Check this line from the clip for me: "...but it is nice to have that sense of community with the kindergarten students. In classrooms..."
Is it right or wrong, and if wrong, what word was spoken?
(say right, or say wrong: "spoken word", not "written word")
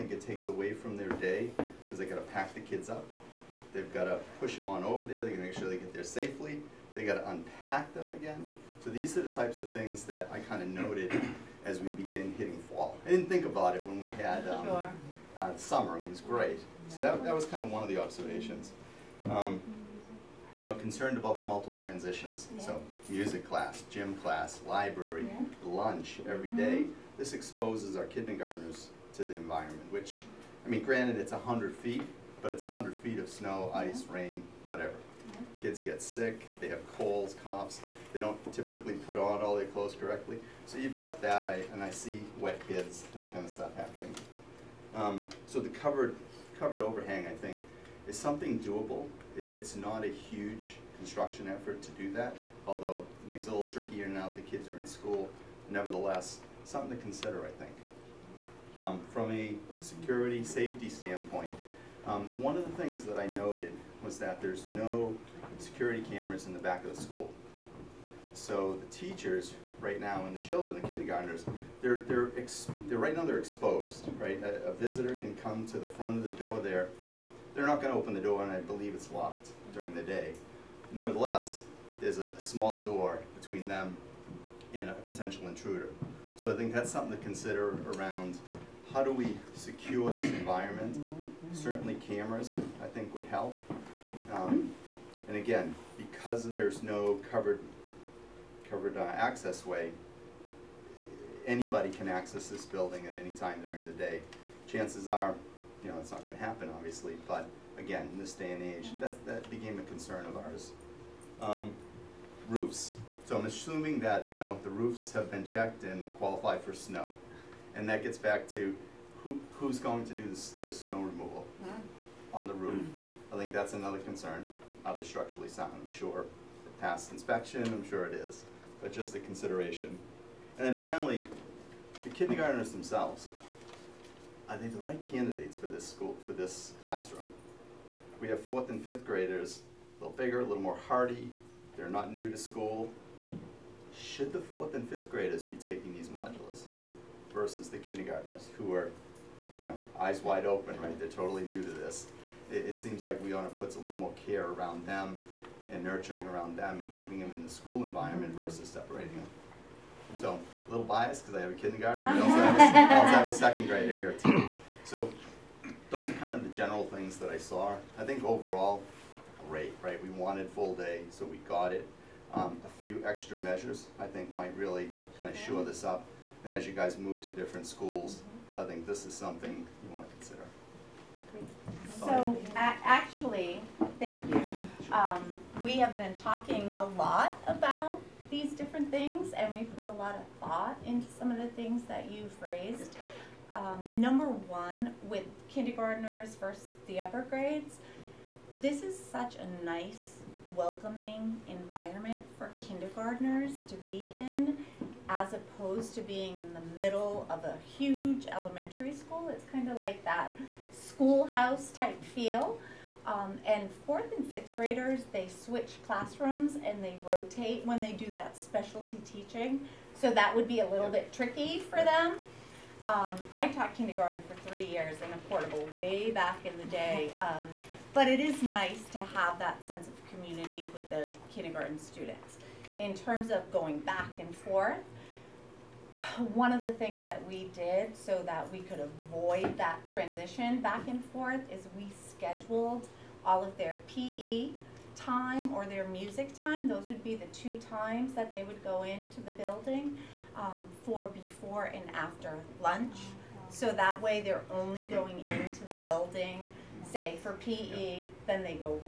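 wrong: "terms", not "classrooms".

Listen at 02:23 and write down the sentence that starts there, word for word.
Should the fourth and fifth graders be taking these modules versus the kindergartners who are, you know, eyes wide open, right?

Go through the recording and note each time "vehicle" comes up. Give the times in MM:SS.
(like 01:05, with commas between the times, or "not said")
not said.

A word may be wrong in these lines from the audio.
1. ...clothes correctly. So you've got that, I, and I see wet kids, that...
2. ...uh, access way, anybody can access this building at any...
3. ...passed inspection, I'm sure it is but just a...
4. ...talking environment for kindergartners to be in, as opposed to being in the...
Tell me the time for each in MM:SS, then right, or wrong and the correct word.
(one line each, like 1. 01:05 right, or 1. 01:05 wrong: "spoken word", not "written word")
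1. 00:39 right
2. 01:38 right
3. 02:06 right
4. 03:20 wrong: "welcoming", not "talking".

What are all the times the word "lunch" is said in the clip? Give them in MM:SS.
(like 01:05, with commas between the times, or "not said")
00:25, 04:12.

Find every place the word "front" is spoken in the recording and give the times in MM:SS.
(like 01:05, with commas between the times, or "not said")
01:15.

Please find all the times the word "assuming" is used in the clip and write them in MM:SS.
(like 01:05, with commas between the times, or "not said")
01:53.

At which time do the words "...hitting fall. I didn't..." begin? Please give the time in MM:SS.
00:12.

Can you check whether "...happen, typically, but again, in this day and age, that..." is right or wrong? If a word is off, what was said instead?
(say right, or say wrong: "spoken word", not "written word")
wrong: "obviously", not "typically".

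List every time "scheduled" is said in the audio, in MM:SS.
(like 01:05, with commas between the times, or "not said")
04:02.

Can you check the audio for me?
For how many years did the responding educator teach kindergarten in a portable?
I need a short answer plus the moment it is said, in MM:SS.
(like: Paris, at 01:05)
3, at 03:44.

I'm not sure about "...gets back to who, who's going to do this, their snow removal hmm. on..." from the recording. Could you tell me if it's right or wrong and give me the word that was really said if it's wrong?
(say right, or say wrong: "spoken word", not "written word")
right.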